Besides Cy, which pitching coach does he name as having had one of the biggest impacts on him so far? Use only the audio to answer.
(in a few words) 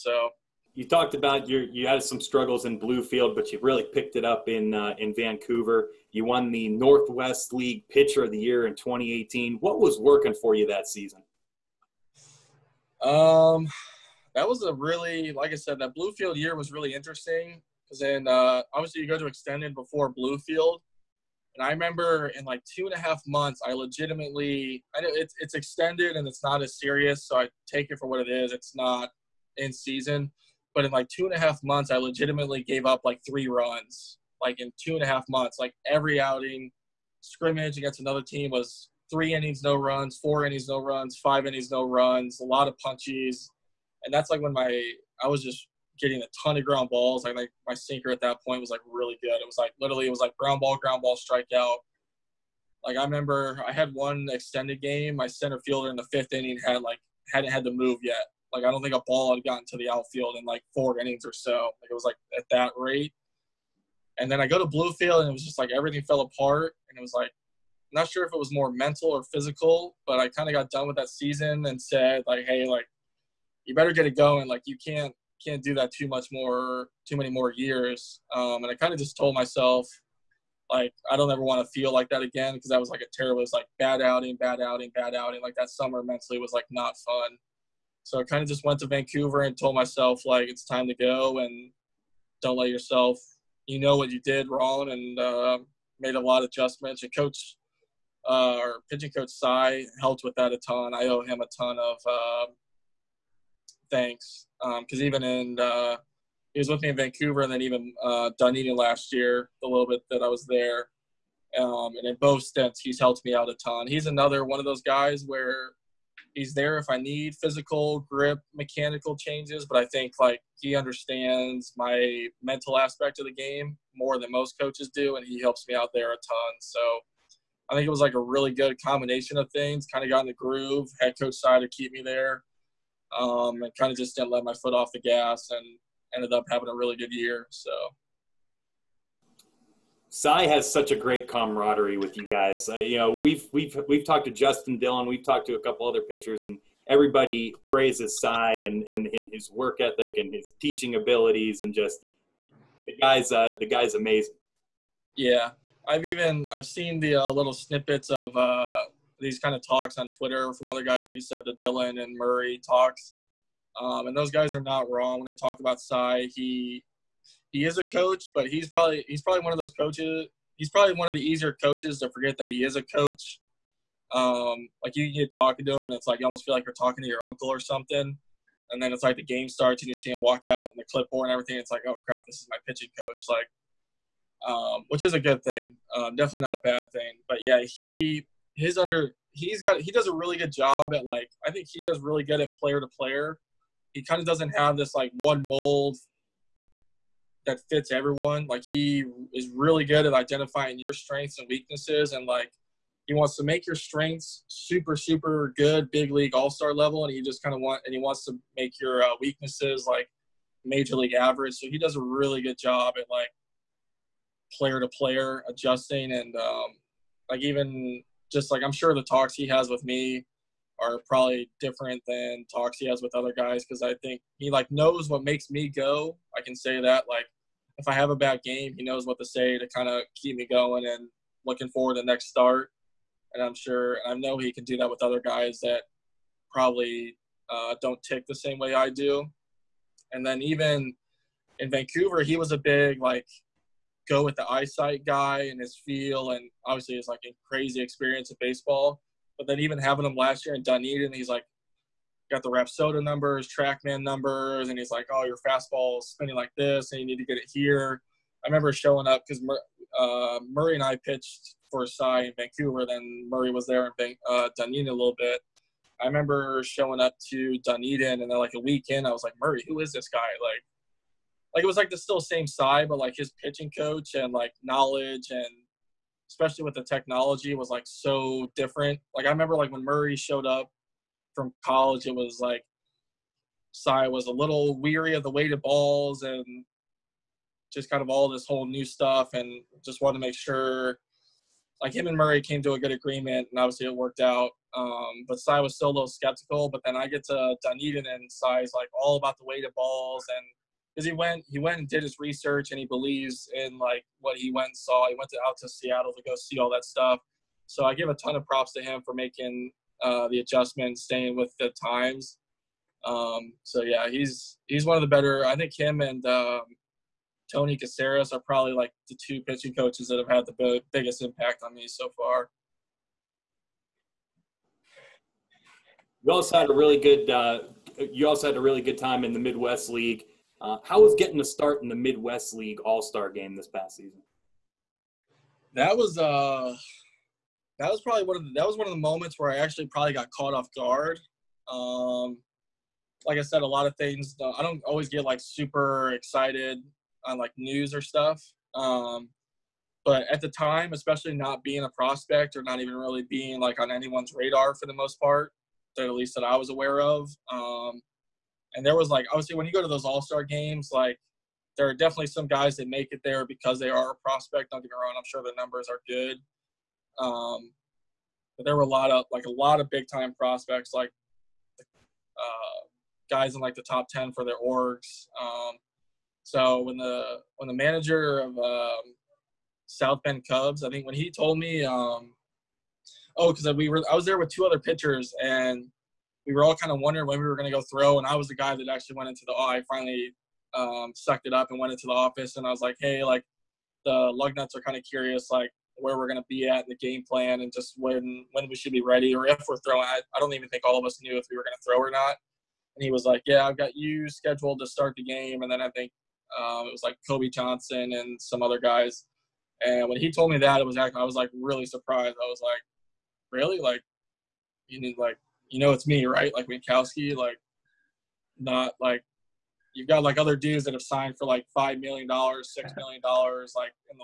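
Tony Caceres.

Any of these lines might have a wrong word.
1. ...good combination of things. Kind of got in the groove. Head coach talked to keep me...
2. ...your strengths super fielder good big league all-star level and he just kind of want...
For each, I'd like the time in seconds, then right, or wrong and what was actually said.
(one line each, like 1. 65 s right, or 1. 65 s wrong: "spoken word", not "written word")
1. 128 s wrong: "decided", not "talked"
2. 203 s wrong: "super", not "fielder".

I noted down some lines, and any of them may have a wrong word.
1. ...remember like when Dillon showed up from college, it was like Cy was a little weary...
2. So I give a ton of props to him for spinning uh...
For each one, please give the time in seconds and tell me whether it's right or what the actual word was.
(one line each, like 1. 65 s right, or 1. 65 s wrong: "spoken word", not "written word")
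1. 279 s wrong: "Murray", not "Dillon"
2. 307 s wrong: "making", not "spinning".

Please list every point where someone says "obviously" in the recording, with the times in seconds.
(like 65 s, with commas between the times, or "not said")
18 s, 246 s, 293 s, 359 s.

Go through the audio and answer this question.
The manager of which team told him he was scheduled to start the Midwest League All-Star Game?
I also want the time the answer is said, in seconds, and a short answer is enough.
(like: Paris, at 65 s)
South Bend Cubs, at 379 s.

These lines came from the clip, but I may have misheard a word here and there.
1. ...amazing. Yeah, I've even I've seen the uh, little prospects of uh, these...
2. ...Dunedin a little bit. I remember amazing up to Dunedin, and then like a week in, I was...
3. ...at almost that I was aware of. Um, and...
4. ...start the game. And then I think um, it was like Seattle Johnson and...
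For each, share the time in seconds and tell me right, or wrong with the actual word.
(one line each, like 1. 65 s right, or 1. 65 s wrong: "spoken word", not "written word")
1. 153 s wrong: "snippets", not "prospects"
2. 264 s wrong: "showing", not "amazing"
3. 355 s wrong: "least", not "almost"
4. 404 s wrong: "Kobe", not "Seattle".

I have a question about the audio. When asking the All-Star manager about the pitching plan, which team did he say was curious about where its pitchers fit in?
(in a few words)
Lugnuts.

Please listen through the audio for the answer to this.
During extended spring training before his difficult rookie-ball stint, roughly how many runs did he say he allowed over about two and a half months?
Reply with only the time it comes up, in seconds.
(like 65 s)
33 s.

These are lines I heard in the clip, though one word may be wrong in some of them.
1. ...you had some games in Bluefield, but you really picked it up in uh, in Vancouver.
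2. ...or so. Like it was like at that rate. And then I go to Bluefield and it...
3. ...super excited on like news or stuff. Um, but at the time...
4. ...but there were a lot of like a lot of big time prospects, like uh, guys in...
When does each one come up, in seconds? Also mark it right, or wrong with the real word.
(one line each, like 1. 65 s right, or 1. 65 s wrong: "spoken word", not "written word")
1. 1 s wrong: "struggles", not "games"
2. 61 s right
3. 345 s right
4. 368 s right.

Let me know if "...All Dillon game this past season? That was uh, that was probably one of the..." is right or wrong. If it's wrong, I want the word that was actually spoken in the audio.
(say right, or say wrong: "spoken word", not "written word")
wrong: "Star", not "Dillon".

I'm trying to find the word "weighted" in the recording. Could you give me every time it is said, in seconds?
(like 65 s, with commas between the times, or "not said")
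285 s, 299 s.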